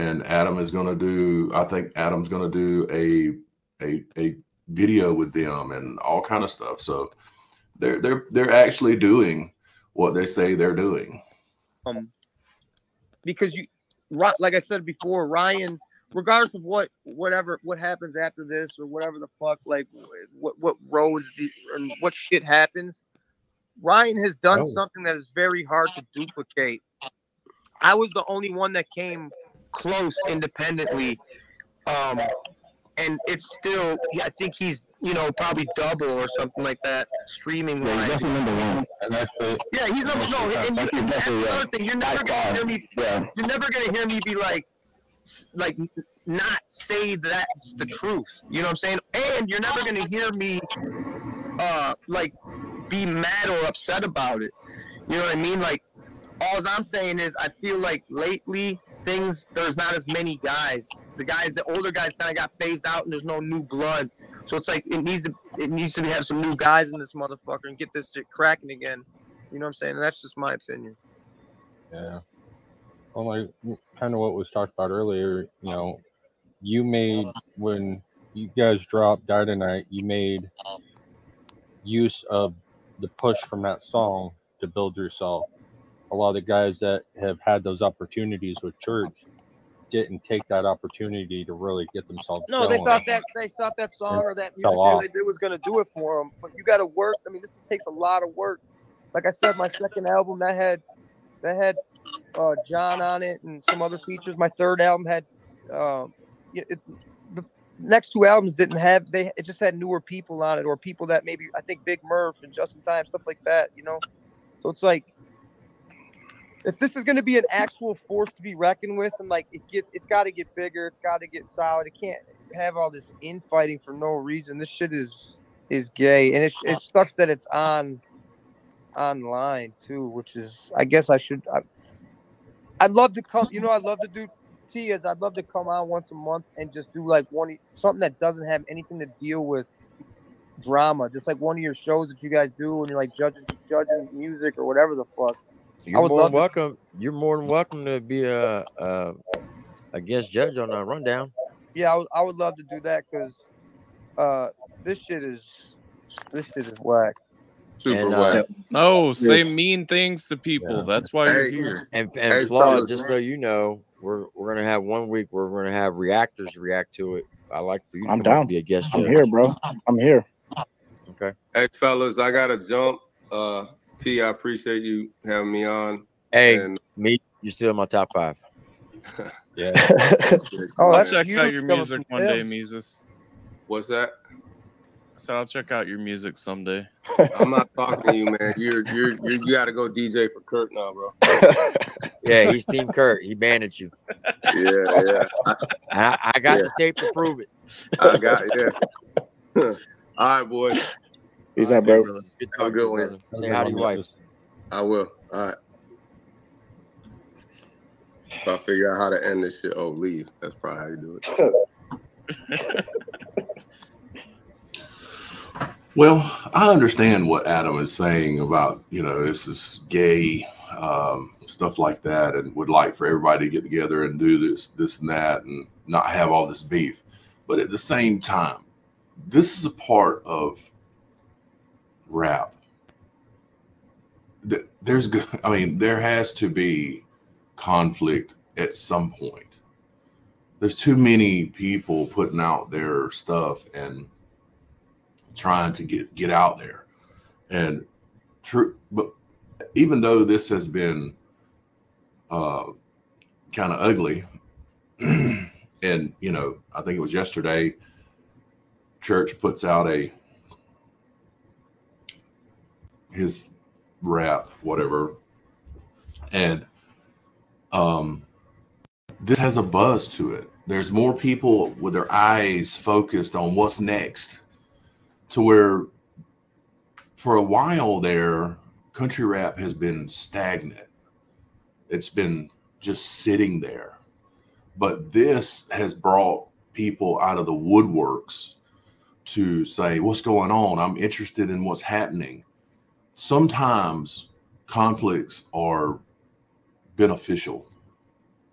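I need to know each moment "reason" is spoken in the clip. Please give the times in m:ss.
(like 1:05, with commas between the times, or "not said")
2:04.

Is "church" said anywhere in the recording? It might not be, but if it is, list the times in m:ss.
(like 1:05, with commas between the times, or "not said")
1:28, 4:19.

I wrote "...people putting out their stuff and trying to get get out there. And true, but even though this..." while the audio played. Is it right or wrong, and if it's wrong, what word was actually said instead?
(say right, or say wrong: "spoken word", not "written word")
right.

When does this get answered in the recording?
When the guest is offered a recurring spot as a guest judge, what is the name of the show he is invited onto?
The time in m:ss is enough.
2:30.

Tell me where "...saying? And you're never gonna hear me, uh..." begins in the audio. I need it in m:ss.
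0:48.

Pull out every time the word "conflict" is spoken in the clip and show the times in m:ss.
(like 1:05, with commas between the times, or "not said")
3:57, 4:54.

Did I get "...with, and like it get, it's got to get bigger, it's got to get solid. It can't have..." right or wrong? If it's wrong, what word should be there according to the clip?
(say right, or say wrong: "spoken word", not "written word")
right.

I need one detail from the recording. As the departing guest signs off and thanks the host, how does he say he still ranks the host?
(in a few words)
Top five.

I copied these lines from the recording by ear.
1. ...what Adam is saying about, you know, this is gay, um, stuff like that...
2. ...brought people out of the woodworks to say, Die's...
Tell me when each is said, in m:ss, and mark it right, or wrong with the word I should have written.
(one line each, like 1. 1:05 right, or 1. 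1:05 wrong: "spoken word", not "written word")
1. 3:37 right
2. 4:45 wrong: "What", not "Die".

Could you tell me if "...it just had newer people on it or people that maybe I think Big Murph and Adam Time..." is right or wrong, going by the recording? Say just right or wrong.
wrong.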